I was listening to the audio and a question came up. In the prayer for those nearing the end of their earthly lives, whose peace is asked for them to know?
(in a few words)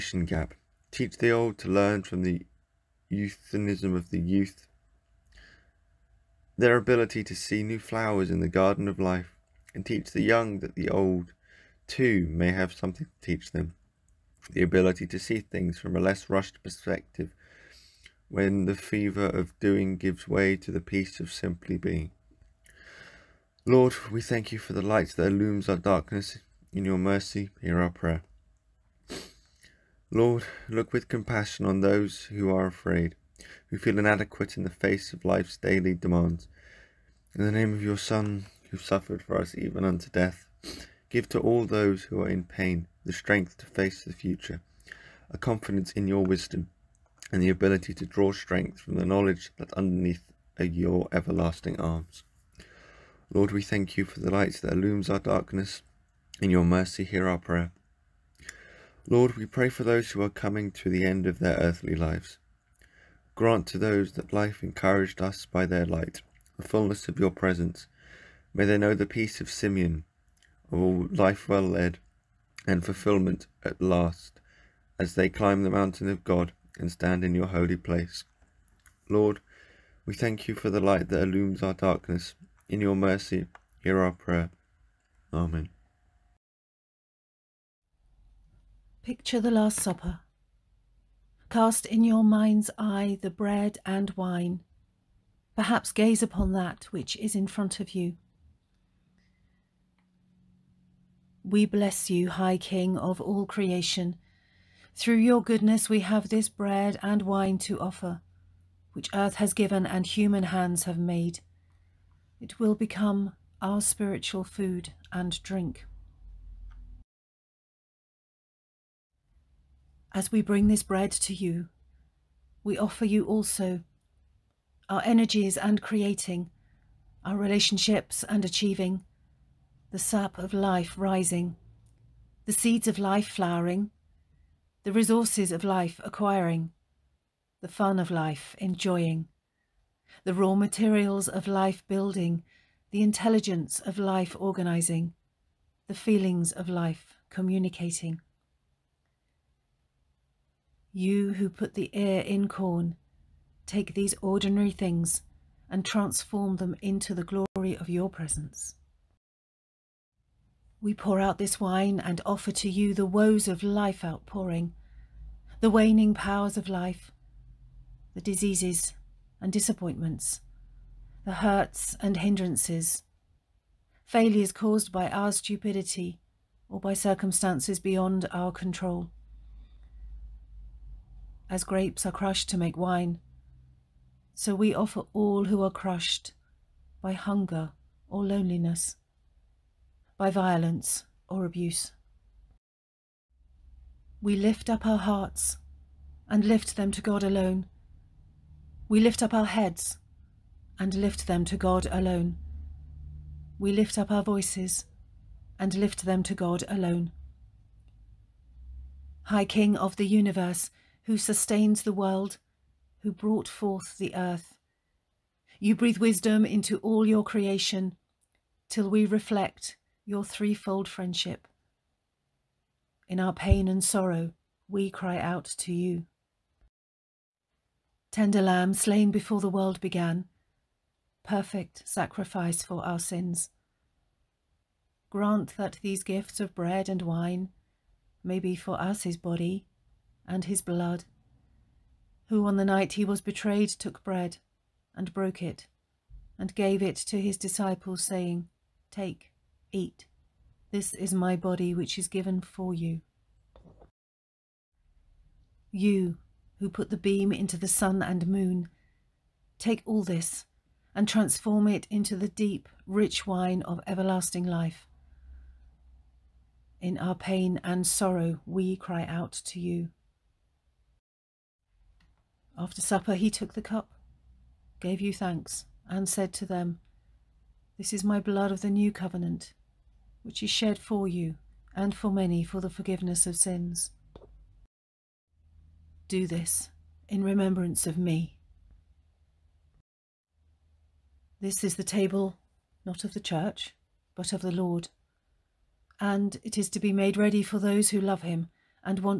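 Simeon.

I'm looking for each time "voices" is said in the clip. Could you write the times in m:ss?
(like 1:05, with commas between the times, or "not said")
3:24.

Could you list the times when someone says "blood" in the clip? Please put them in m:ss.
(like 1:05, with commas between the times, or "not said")
4:00, 4:38.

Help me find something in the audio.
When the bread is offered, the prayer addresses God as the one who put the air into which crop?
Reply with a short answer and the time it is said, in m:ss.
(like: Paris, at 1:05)
Corn, at 2:32.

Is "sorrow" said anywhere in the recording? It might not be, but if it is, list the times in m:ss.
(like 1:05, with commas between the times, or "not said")
3:43, 4:27.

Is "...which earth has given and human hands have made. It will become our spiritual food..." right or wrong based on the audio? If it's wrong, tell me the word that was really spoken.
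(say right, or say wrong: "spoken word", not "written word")
right.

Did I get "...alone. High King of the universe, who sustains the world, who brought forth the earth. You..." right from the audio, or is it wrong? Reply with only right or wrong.
right.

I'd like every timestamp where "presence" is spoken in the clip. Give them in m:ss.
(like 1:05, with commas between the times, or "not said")
1:07, 2:38.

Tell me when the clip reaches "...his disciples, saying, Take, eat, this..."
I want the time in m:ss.
4:07.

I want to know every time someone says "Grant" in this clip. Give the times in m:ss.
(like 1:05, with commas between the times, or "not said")
1:03, 3:55.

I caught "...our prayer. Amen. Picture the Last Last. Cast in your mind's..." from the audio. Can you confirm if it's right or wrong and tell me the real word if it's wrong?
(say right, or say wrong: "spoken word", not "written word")
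wrong: "Supper", not "Last".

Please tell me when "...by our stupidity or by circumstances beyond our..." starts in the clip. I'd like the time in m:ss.
2:54.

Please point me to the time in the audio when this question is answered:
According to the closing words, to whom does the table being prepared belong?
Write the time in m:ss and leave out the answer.
4:54.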